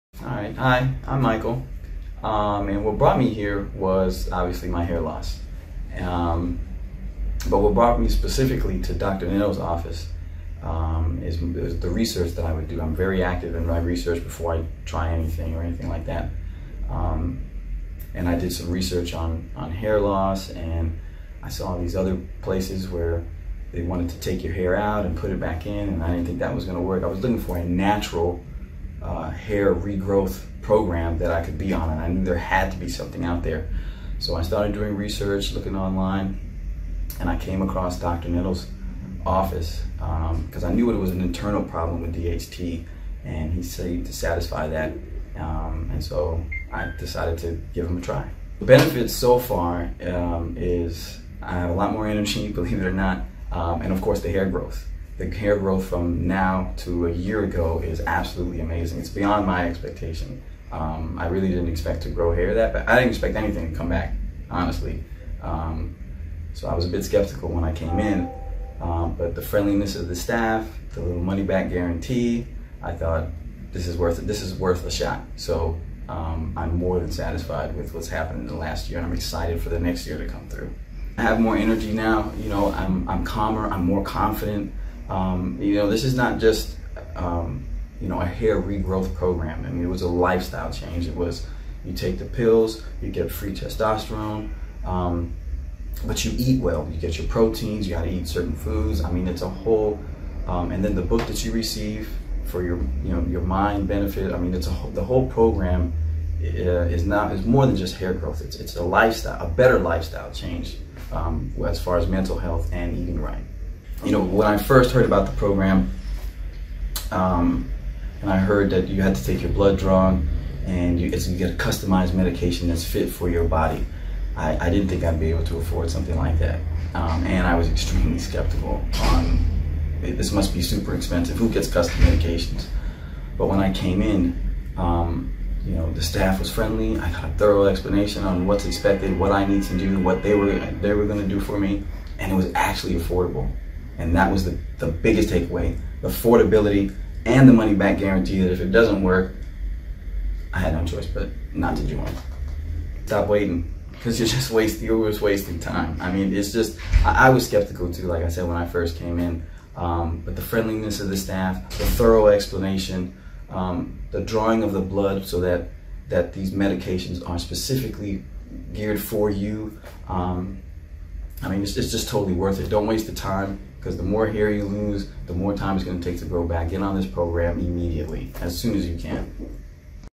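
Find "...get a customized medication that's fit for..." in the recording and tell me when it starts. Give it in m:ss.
2:01.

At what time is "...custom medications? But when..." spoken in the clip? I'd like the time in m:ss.
2:11.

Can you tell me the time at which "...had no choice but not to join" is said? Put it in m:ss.
2:30.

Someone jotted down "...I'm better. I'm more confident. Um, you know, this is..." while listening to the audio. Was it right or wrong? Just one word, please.
wrong.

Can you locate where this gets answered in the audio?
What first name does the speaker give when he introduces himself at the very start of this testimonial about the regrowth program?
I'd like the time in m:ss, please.
0:01.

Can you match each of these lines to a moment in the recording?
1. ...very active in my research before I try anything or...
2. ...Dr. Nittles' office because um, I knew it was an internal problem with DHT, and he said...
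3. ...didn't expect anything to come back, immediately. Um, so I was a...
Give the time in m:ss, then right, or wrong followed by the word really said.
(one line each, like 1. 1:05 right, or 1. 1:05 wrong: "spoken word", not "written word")
1. 0:12 right
2. 0:37 right
3. 1:02 wrong: "honestly", not "immediately".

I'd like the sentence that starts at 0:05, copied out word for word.
Um, but what brought me specifically to Dr.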